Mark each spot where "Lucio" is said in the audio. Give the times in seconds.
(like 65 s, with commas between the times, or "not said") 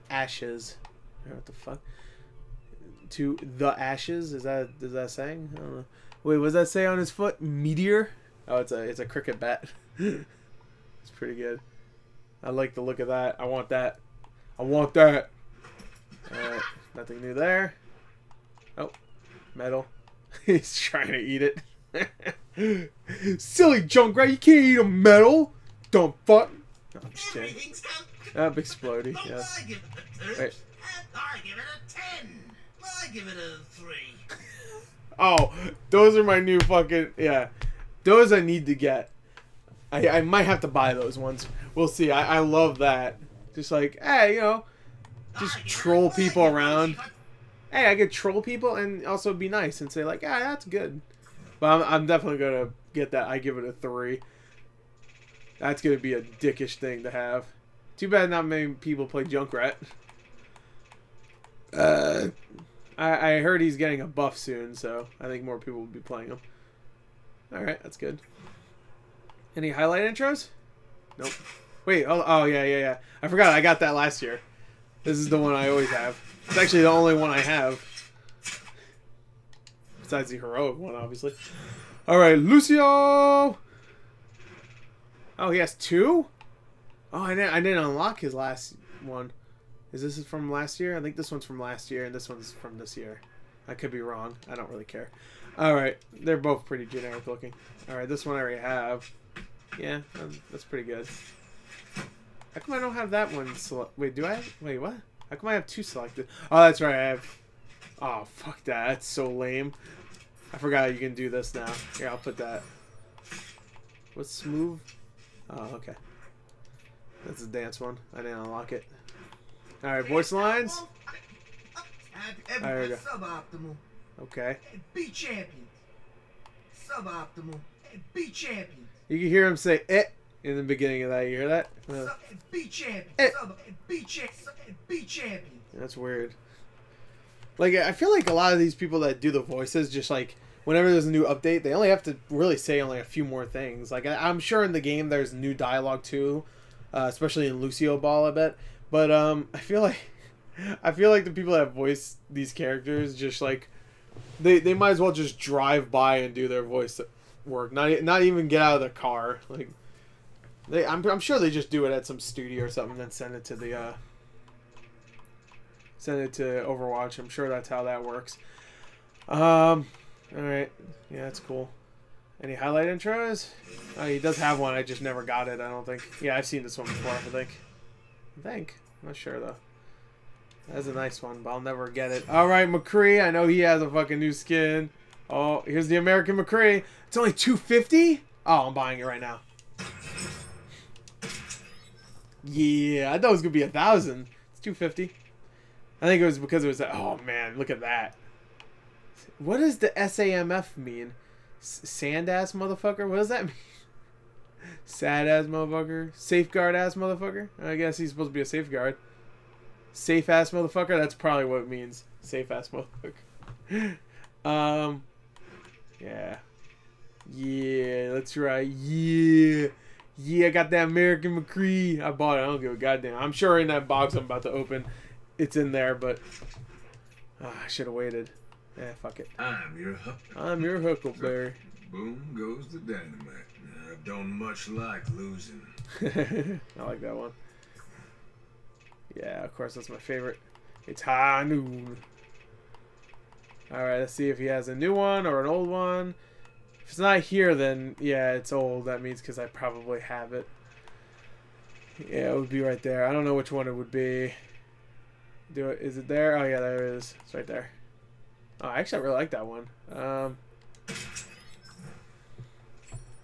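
82 s, 147 s.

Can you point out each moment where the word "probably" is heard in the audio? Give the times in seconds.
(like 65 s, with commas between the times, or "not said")
211 s, 249 s.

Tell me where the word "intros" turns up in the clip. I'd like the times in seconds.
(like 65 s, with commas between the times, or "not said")
70 s, 172 s.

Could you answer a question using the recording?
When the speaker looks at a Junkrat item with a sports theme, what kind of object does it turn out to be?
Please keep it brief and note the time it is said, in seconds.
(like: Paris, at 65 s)
cricket bat, at 9 s.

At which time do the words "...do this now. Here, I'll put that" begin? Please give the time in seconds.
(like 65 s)
111 s.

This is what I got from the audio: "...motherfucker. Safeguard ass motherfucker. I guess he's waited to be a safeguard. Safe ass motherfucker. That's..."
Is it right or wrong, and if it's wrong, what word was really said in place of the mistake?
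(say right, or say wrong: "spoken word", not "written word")
wrong: "supposed", not "waited".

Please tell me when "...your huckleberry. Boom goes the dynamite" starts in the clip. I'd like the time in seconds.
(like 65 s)
230 s.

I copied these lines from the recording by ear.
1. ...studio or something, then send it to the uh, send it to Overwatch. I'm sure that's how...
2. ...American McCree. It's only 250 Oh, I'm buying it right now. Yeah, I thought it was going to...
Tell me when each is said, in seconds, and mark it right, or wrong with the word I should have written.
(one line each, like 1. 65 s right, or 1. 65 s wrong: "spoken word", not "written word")
1. 162 s right
2. 185 s right.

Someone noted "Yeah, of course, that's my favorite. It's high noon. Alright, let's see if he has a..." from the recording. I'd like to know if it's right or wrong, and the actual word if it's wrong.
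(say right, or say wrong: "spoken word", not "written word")
right.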